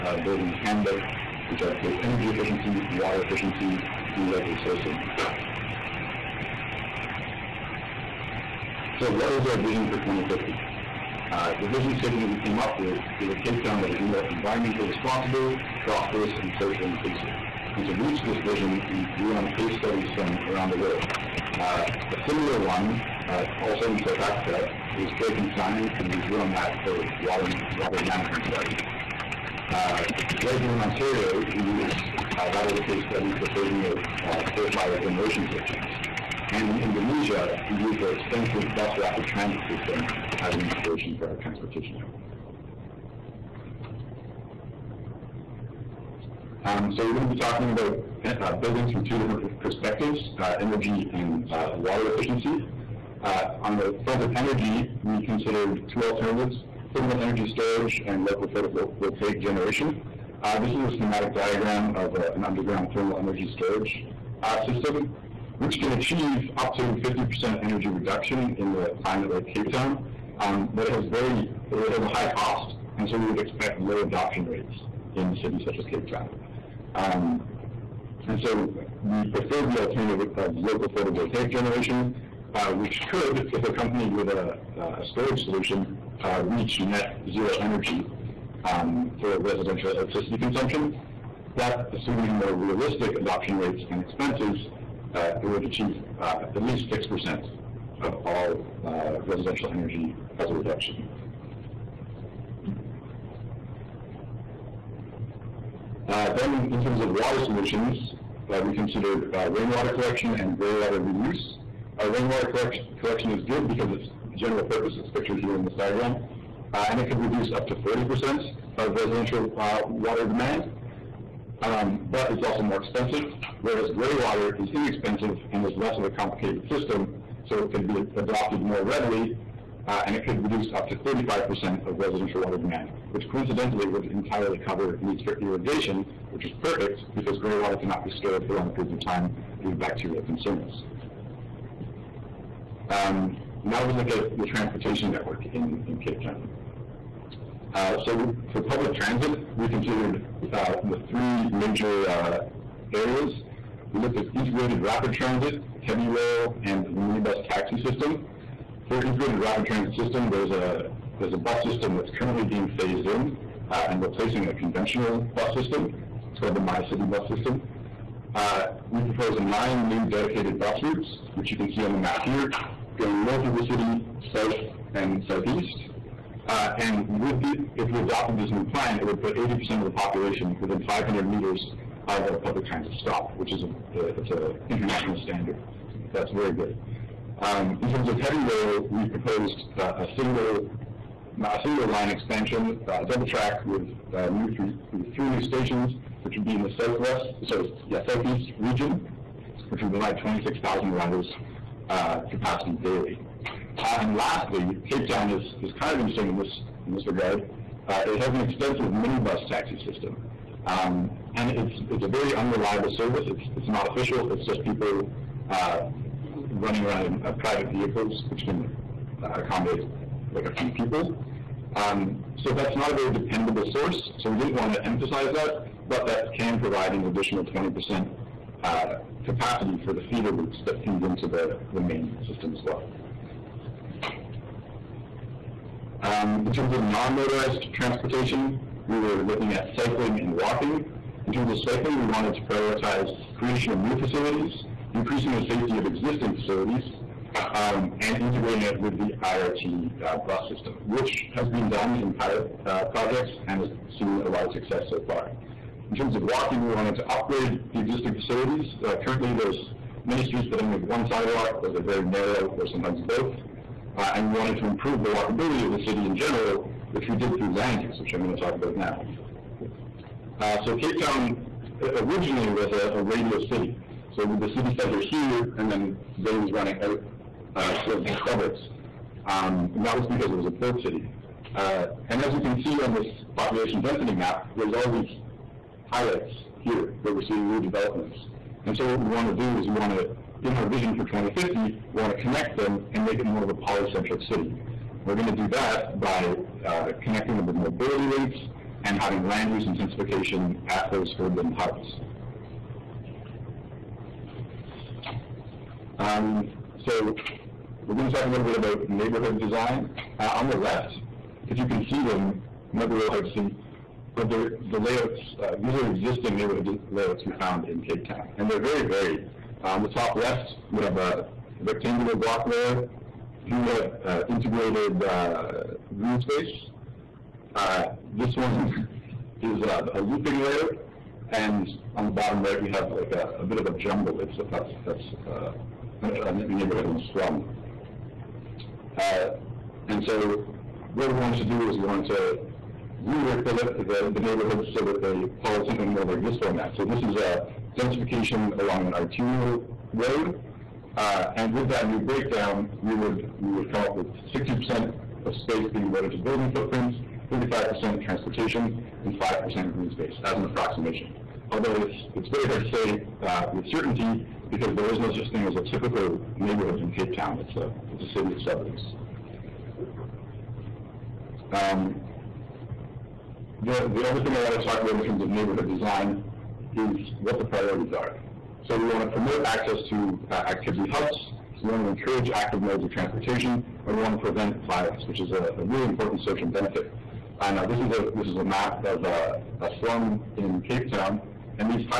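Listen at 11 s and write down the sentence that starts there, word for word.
Uh, the vision statement we came up with is a Cape Town that is more environmentally responsible, prosperous, and socially inclusive.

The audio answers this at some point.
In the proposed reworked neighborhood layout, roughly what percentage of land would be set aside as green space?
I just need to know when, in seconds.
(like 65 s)
359 s.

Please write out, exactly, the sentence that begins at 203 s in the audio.
Uh, and lastly, Cape Town is, is kind of interesting in this, in this regard.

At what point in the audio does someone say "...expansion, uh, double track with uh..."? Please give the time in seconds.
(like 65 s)
192 s.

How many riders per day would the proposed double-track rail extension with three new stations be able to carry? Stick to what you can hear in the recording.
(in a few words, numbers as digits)
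26,000.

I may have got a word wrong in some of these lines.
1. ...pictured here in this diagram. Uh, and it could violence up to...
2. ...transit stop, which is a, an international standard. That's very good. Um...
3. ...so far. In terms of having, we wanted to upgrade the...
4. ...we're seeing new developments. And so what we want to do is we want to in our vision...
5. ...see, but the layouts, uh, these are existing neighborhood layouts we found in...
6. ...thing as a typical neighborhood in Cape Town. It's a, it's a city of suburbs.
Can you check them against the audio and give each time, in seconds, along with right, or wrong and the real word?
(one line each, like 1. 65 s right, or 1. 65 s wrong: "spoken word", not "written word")
1. 115 s wrong: "reduce", not "violence"
2. 182 s right
3. 254 s wrong: "walking", not "having"
4. 287 s right
5. 313 s right
6. 365 s right.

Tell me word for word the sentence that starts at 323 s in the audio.
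Here we have uh, integrated uh, green space.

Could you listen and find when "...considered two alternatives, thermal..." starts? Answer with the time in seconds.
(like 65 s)
55 s.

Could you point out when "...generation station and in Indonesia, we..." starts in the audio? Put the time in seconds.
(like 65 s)
34 s.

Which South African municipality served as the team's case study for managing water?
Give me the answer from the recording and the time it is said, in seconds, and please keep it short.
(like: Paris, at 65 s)
Drakenstein, at 25 s.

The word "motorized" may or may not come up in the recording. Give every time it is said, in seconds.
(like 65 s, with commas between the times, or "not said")
236 s.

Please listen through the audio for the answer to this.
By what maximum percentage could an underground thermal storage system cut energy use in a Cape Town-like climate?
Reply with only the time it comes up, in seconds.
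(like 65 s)
67 s.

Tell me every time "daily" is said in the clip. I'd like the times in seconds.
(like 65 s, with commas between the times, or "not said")
202 s.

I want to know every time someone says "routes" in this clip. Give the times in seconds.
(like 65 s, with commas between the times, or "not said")
170 s, 230 s.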